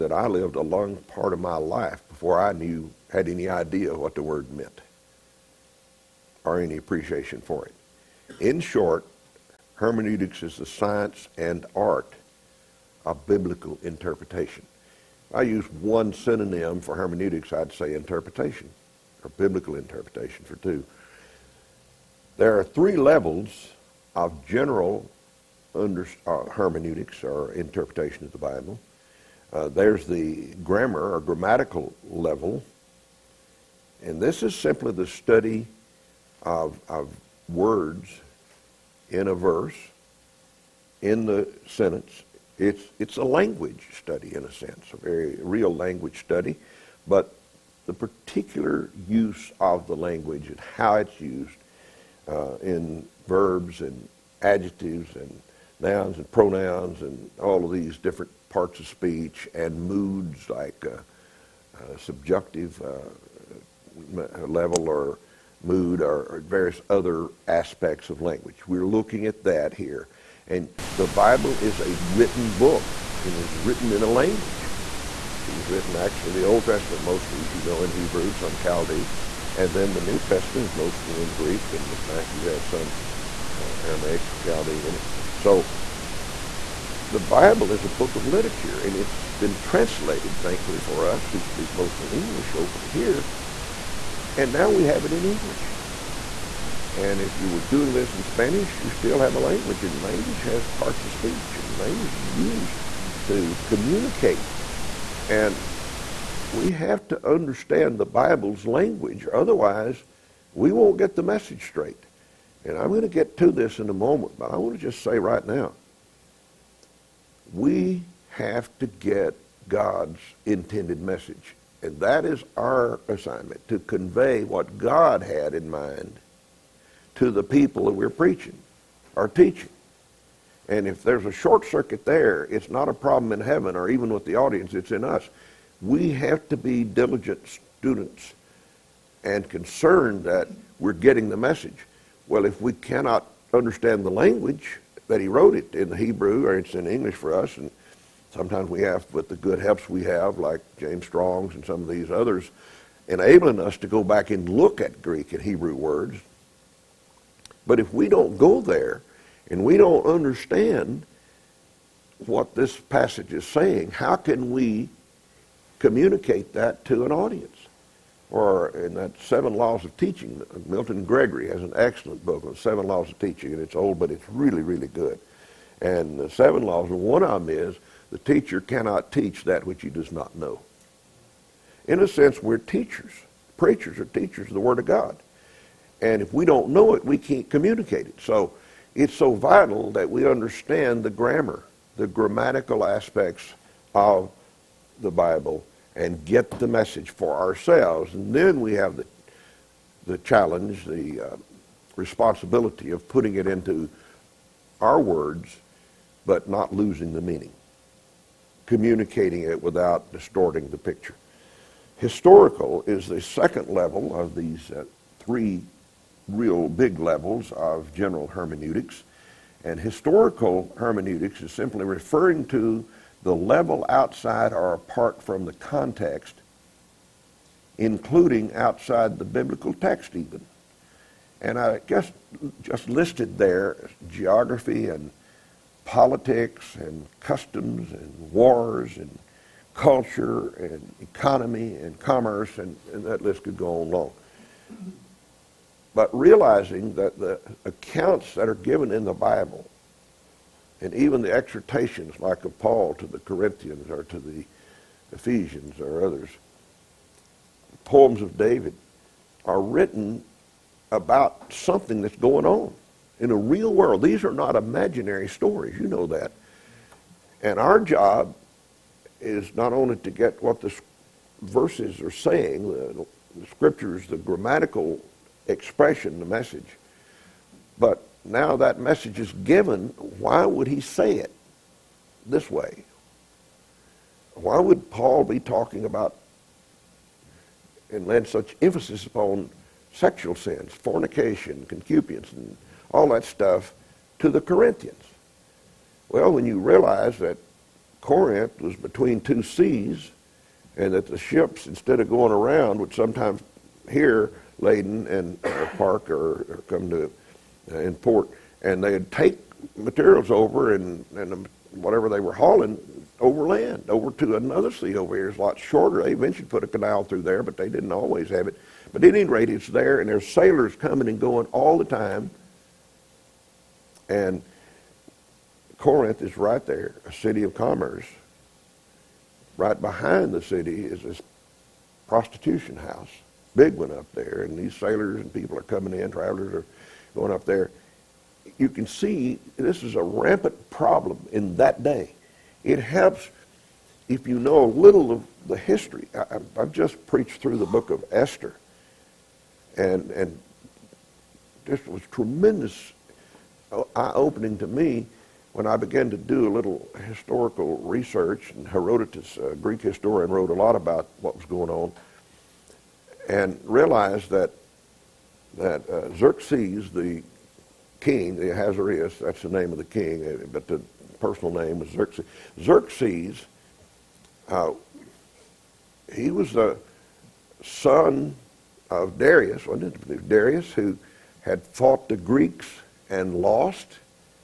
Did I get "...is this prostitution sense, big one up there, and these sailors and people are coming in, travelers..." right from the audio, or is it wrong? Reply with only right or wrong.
wrong.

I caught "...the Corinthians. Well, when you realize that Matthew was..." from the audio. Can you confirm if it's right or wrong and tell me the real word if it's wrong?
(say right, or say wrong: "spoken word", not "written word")
wrong: "Corinth", not "Matthew".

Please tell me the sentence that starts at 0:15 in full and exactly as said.
I use one synonym for hermeneutics, I'd say interpretation, or biblical interpretation for two.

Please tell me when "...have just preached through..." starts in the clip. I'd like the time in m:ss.
5:46.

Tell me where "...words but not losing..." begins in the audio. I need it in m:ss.
3:25.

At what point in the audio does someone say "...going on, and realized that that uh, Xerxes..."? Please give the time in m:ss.
6:01.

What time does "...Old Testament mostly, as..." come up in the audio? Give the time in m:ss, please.
1:16.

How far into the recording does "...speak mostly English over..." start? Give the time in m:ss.
1:31.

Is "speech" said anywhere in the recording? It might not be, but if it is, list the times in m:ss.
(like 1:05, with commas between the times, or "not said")
0:58, 1:41.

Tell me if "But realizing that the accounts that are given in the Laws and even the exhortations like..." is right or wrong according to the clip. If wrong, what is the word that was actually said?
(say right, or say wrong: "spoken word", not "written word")
wrong: "Bible", not "Laws".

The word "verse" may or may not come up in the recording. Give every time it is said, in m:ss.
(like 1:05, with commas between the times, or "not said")
0:39, 4:31.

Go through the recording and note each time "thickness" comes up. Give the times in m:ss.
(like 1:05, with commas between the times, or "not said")
not said.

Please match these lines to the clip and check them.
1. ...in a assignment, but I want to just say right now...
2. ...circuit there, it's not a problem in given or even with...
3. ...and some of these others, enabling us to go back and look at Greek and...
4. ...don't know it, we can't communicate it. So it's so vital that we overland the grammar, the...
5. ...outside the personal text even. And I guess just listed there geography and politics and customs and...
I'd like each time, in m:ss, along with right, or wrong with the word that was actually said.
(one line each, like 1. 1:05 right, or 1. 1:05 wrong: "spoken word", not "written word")
1. 1:53 wrong: "moment", not "assignment"
2. 2:11 wrong: "heaven", not "given"
3. 2:31 right
4. 3:06 wrong: "understand", not "overland"
5. 3:48 wrong: "biblical", not "personal".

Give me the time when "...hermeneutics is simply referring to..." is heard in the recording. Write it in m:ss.
3:40.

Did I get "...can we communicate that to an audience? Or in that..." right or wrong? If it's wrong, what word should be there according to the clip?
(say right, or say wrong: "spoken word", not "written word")
right.